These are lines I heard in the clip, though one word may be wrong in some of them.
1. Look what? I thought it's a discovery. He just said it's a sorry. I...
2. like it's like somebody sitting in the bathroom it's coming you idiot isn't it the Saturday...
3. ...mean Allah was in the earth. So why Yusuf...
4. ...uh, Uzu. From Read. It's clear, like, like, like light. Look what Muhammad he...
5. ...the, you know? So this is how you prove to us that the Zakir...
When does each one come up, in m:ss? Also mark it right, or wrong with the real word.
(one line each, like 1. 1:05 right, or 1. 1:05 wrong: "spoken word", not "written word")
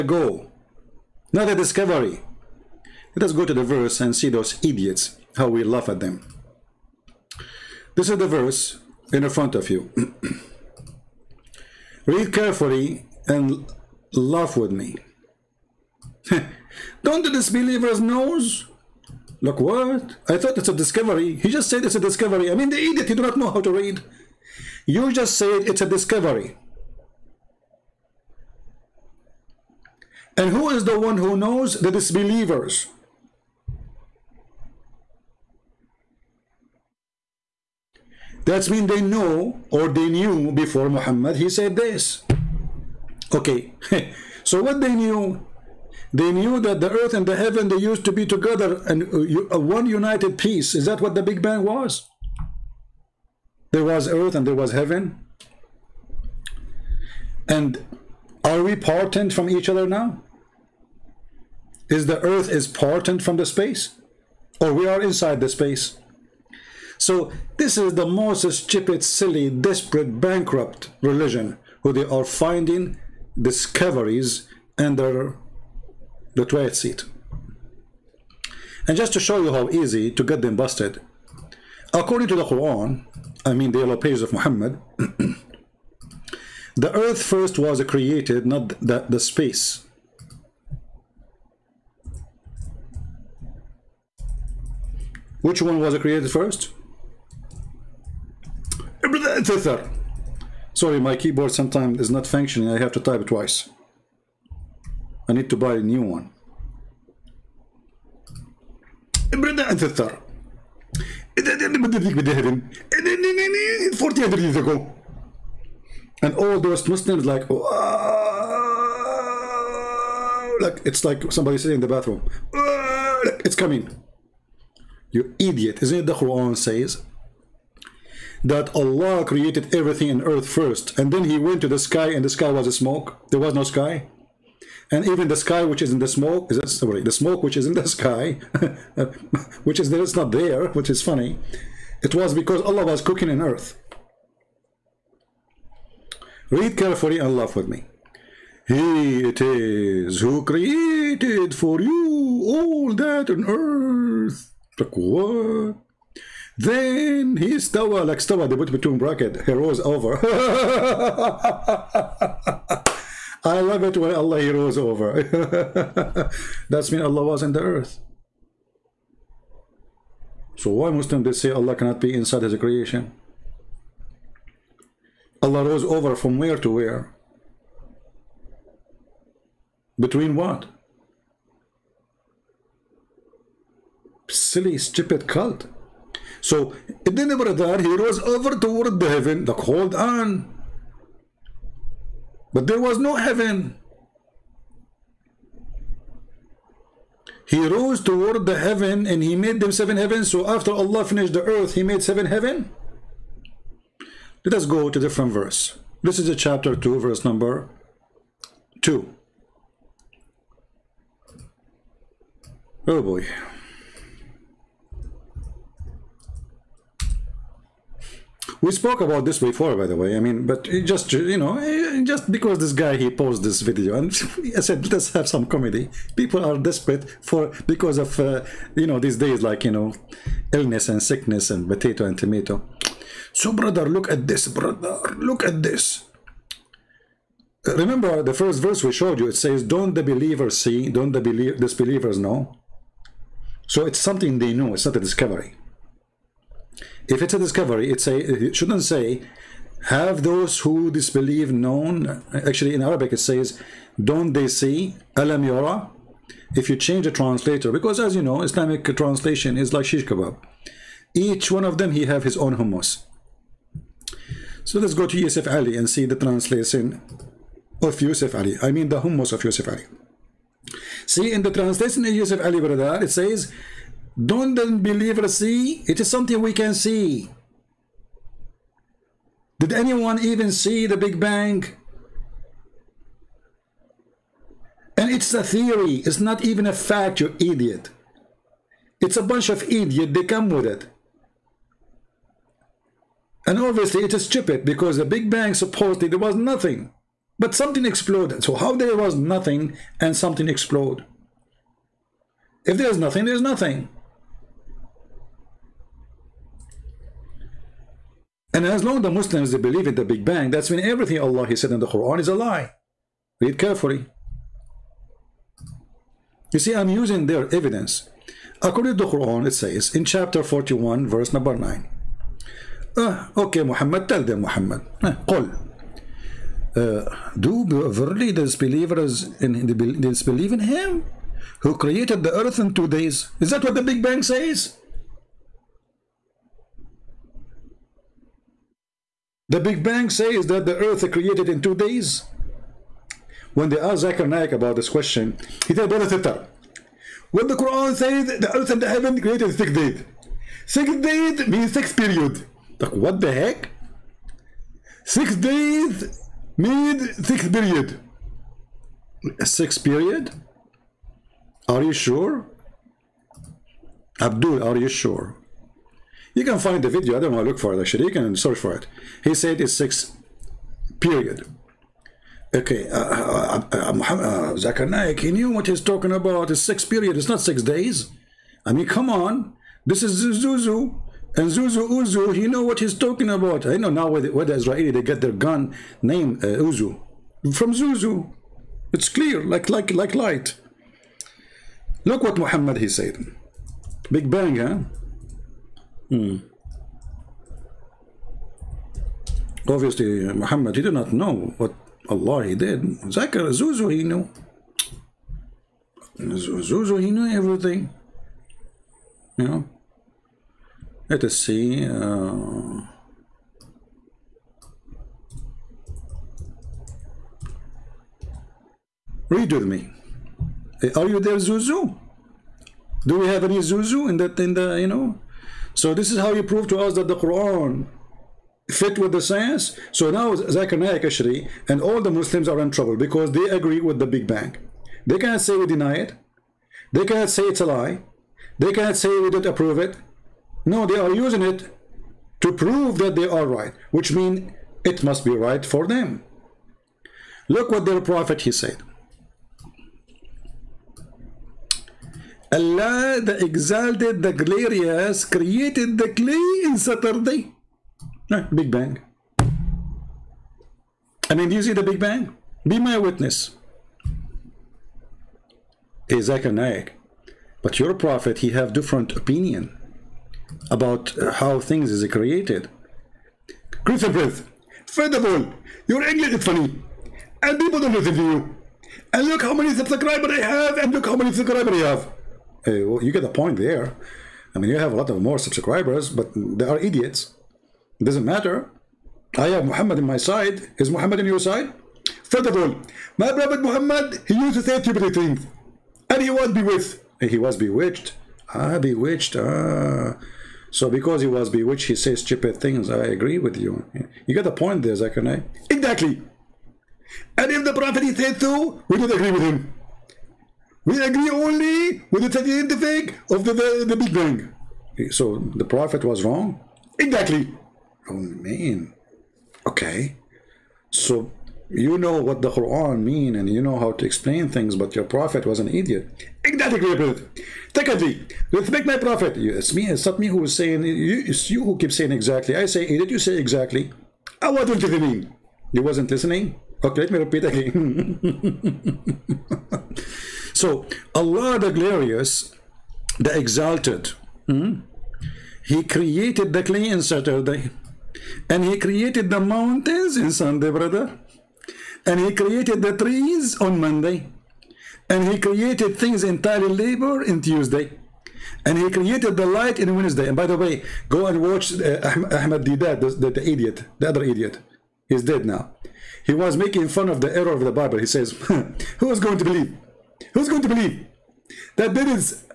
1. 0:19 wrong: "discovery", not "sorry"
2. 2:00 wrong: "Quran", not "Saturday"
3. 2:46 wrong: "Muslim", not "Yusuf"
4. 6:26 wrong: "Zuzu", not "Read"
5. 7:04 wrong: "Quran", not "Zakir".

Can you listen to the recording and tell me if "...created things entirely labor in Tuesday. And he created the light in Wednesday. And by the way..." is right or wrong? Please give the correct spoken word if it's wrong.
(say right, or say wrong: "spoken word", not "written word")
right.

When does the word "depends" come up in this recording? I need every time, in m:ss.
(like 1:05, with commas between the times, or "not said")
not said.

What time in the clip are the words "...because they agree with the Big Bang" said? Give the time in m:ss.
7:12.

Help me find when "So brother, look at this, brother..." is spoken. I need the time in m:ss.
3:53.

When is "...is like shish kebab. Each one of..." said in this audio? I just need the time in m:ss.
4:19.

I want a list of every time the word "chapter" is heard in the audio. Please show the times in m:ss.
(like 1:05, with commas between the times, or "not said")
3:26, 5:20.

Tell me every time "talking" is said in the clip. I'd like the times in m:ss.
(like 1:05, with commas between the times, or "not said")
6:15, 6:22.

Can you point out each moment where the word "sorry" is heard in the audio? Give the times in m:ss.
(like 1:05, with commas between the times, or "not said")
1:40, 2:16.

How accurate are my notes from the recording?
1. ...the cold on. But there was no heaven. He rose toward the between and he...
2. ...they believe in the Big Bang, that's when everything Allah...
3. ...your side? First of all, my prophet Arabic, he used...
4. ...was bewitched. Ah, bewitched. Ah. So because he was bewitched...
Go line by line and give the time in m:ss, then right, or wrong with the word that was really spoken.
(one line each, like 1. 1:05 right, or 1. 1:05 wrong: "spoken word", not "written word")
1. 3:09 wrong: "heaven", not "between"
2. 5:09 right
3. 8:11 wrong: "Muhammad", not "Arabic"
4. 8:17 right.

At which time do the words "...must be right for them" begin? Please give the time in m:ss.
7:25.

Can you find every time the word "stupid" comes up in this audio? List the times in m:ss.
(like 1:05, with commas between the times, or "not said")
1:08, 3:04, 4:54, 8:14, 8:22.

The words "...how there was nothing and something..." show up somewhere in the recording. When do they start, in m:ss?
4:58.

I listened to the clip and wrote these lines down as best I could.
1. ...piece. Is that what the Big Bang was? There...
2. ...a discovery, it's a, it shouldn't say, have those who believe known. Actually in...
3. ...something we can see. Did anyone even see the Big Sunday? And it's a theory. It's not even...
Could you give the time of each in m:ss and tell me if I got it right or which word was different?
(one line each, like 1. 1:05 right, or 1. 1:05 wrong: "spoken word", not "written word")
1. 0:50 right
2. 4:07 wrong: "disbelieve", not "believe"
3. 4:36 wrong: "Bang", not "Sunday".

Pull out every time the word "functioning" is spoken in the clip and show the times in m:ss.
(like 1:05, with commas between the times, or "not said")
1:42.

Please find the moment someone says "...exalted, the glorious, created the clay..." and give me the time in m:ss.
7:33.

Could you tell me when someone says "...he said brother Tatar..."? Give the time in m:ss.
5:45.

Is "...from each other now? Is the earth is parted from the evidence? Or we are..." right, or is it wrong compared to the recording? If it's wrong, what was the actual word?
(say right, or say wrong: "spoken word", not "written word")
wrong: "space", not "evidence".